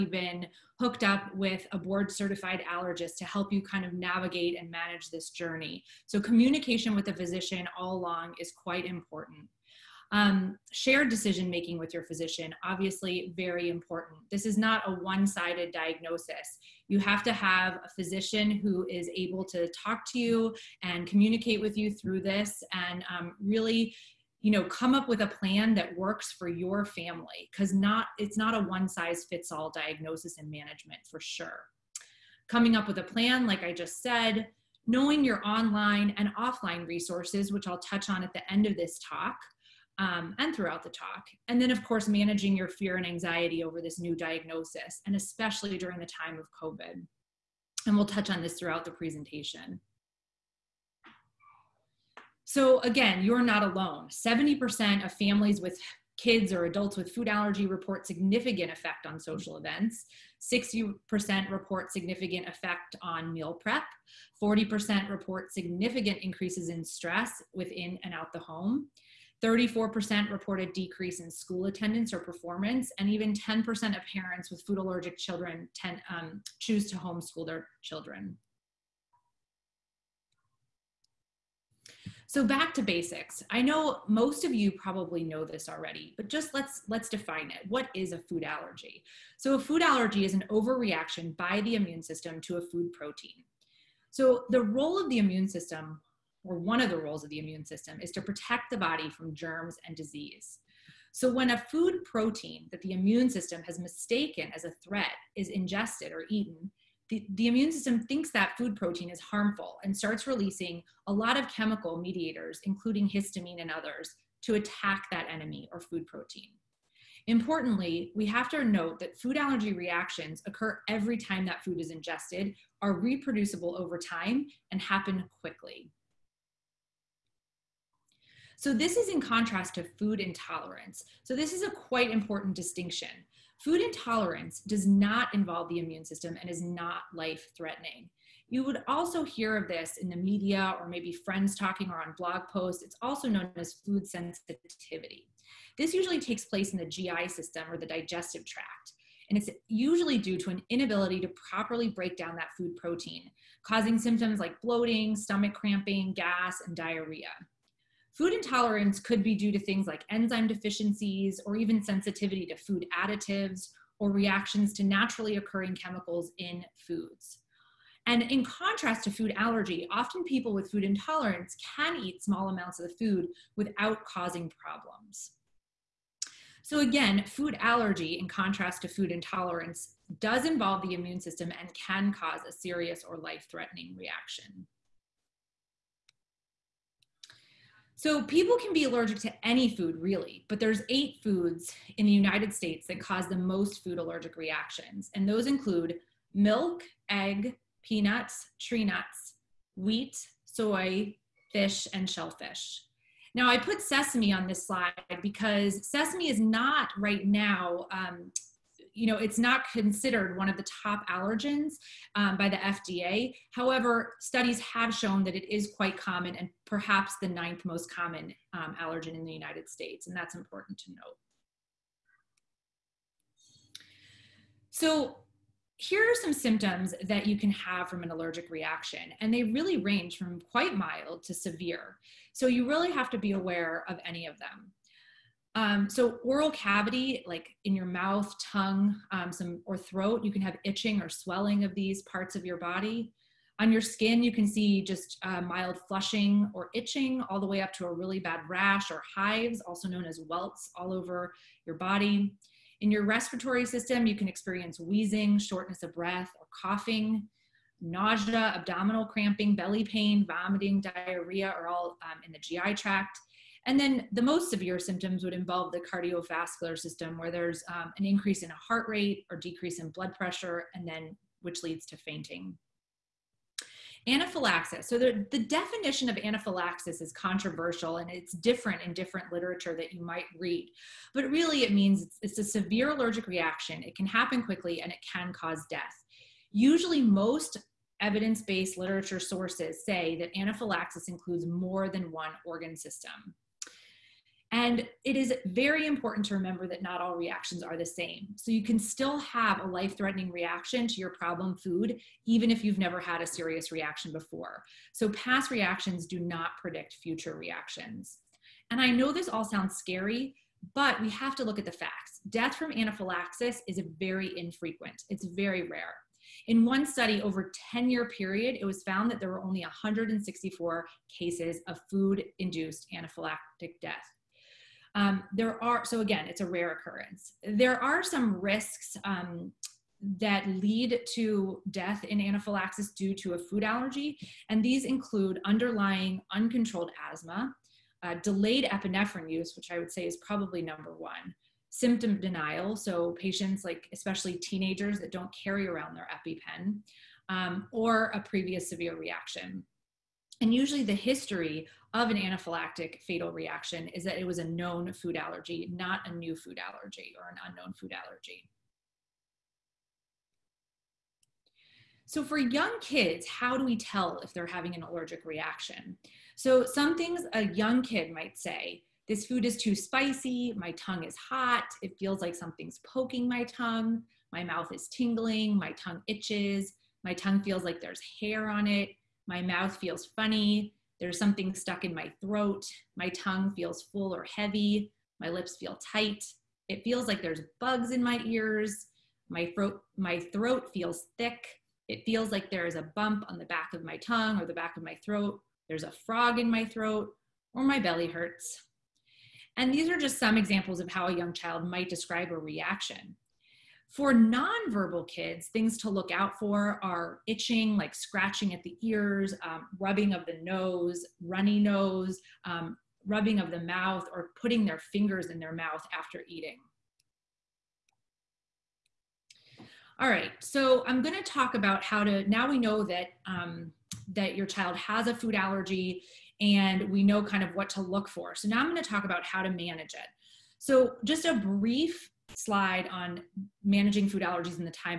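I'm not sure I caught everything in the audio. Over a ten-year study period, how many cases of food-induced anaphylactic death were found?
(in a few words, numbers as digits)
164.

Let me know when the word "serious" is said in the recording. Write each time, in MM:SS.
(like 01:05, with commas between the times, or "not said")
03:02, 05:03.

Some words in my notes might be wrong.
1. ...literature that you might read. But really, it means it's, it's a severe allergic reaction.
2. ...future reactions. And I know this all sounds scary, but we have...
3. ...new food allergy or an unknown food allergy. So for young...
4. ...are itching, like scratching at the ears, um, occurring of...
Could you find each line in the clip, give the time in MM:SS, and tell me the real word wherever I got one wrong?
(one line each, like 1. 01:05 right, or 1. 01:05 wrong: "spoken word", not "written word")
1. 04:39 right
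2. 05:07 right
3. 05:56 right
4. 06:46 wrong: "rubbing", not "occurring".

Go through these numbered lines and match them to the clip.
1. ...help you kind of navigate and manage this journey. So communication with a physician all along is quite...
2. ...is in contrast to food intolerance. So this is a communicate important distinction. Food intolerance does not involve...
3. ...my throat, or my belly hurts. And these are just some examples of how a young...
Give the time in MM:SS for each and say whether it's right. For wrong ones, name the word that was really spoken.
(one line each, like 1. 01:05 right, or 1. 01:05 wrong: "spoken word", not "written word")
1. 00:03 right
2. 02:08 wrong: "quite", not "communicate"
3. 06:36 right.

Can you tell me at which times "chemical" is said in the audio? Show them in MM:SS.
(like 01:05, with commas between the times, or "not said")
01:51, 02:45.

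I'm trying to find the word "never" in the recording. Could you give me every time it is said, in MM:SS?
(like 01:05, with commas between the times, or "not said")
05:02.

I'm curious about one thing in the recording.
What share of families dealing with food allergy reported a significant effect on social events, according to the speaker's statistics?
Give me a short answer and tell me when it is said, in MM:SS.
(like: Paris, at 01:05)
70%, at 00:54.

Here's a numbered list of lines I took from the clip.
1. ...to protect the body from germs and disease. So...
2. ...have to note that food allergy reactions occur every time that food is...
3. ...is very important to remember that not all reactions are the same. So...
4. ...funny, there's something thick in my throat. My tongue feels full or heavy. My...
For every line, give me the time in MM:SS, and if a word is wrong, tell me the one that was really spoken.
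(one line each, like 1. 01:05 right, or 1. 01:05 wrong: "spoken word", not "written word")
1. 01:38 right
2. 01:58 right
3. 04:55 right
4. 06:20 wrong: "stuck", not "thick".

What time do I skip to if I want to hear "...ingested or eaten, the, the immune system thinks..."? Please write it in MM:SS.
01:45.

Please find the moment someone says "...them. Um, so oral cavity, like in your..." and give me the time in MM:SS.
03:54.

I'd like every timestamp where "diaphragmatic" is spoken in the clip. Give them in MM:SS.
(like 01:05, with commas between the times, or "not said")
not said.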